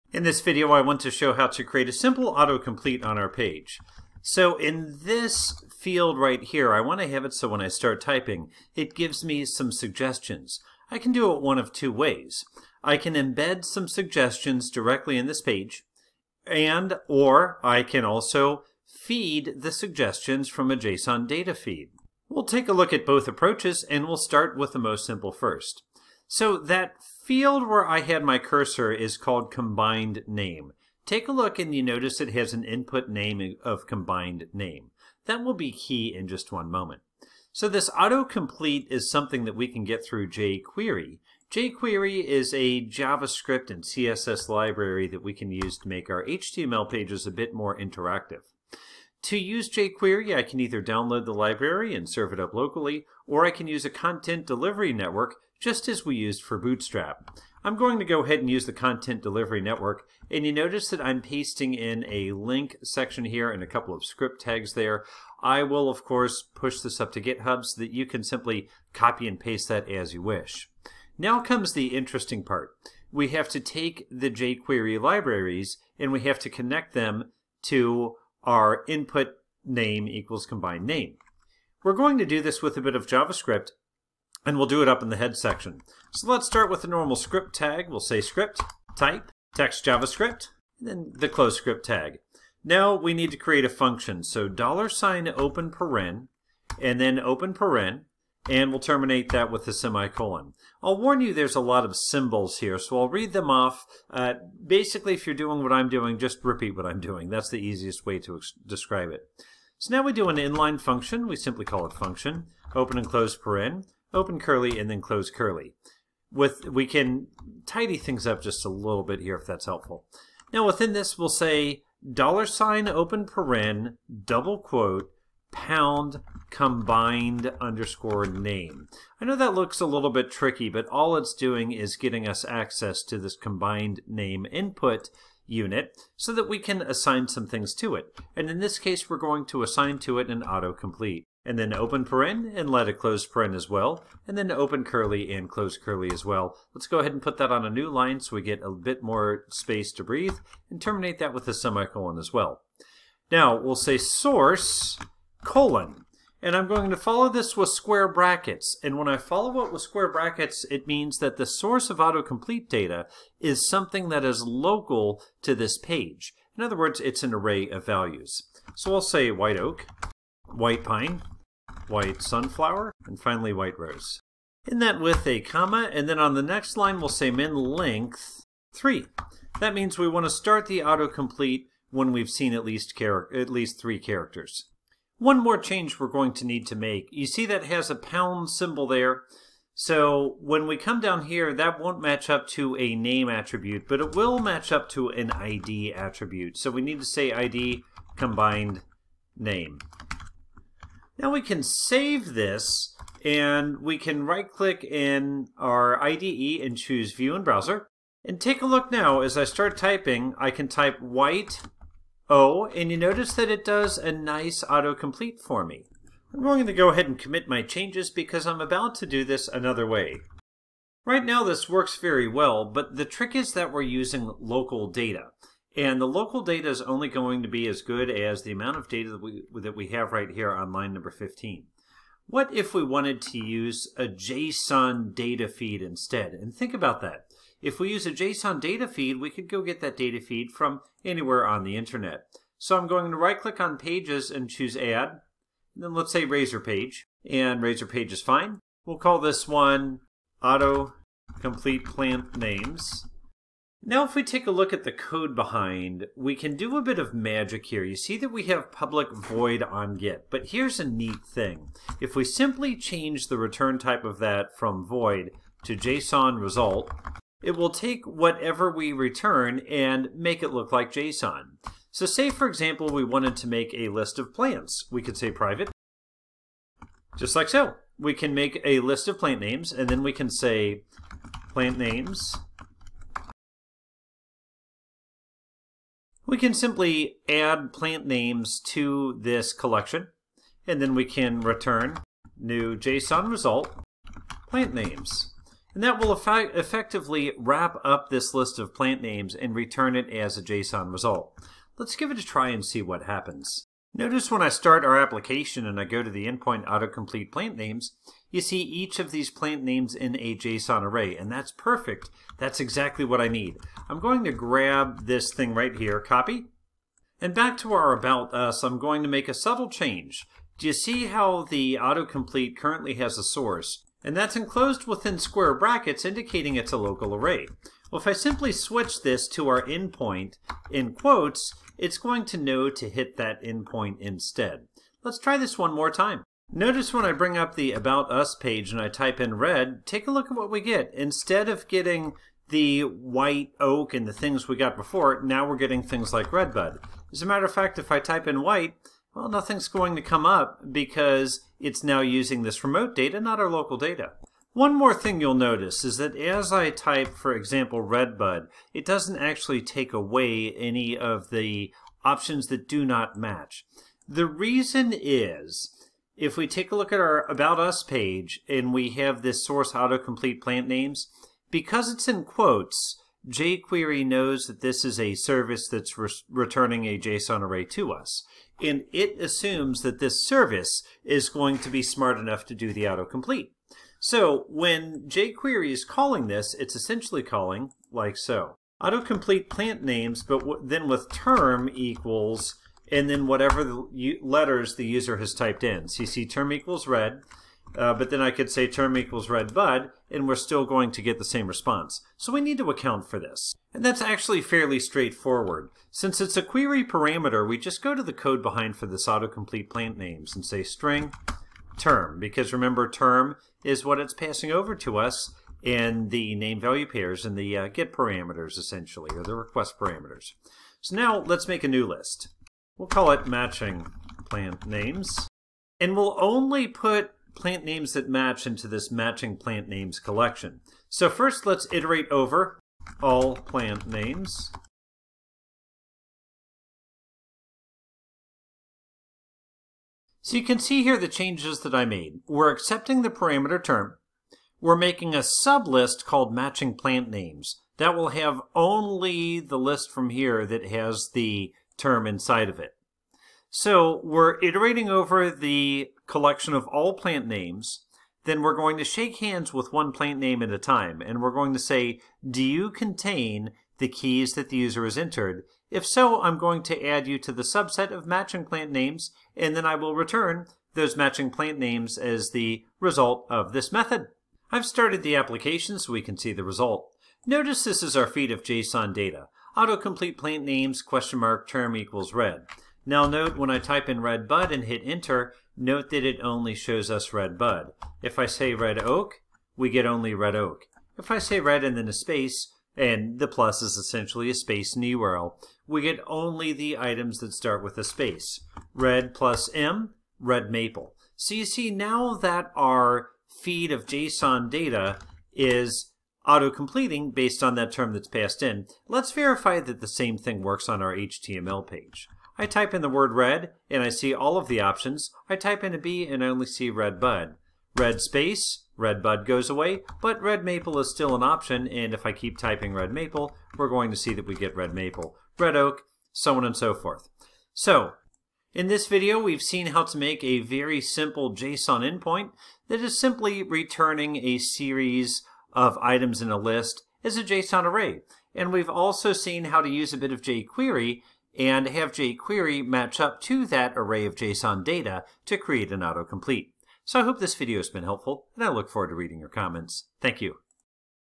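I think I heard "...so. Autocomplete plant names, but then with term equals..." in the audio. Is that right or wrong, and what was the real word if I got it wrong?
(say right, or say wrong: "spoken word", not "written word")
right.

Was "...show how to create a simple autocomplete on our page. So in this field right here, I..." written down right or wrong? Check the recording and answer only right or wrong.
right.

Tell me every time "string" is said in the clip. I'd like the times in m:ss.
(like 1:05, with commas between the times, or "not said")
6:50.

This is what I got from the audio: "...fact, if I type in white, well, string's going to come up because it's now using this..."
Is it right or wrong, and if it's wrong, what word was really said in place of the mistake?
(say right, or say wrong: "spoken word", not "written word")
wrong: "nothing", not "string".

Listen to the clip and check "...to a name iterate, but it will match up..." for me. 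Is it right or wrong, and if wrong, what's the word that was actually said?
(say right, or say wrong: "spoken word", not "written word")
wrong: "attribute", not "iterate".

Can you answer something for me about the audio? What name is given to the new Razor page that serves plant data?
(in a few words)
auto complete plant names.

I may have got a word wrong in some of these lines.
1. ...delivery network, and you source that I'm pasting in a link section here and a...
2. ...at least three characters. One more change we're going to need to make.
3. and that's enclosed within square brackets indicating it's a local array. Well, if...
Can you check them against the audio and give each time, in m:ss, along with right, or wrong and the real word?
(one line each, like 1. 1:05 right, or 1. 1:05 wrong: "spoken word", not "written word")
1. 0:59 wrong: "notice", not "source"
2. 3:02 right
3. 5:24 right.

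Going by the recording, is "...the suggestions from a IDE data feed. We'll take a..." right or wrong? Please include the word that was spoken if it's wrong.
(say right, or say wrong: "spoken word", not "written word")
wrong: "JSON", not "IDE".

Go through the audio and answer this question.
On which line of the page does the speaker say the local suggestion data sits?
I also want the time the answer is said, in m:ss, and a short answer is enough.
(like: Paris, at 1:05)
15, at 3:50.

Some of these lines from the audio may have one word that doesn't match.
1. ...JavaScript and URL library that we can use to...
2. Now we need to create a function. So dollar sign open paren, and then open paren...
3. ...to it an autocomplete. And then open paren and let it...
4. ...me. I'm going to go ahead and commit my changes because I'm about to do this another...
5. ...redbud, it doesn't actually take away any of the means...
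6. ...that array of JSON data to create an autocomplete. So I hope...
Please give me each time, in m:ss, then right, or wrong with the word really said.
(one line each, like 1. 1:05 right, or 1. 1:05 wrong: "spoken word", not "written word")
1. 0:42 wrong: "CSS", not "URL"
2. 1:32 right
3. 2:19 right
4. 3:35 right
5. 5:57 wrong: "options", not "means"
6. 9:03 right.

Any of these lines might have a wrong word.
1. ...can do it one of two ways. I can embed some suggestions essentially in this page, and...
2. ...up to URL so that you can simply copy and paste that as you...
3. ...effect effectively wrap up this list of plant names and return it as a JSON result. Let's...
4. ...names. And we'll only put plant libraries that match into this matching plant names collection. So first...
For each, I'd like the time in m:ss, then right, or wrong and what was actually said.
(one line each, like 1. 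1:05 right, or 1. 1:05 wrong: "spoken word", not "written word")
1. 0:10 wrong: "directly", not "essentially"
2. 1:06 wrong: "GitHub", not "URL"
3. 4:56 right
4. 7:04 wrong: "names", not "libraries".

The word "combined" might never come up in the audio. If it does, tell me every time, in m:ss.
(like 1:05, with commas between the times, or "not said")
0:29, 0:33, 1:20, 2:06, 2:13, 3:18.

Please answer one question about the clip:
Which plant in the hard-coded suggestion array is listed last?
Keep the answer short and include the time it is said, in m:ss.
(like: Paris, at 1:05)
white rose, at 2:53.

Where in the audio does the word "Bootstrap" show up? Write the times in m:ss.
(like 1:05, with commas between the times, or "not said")
0:56.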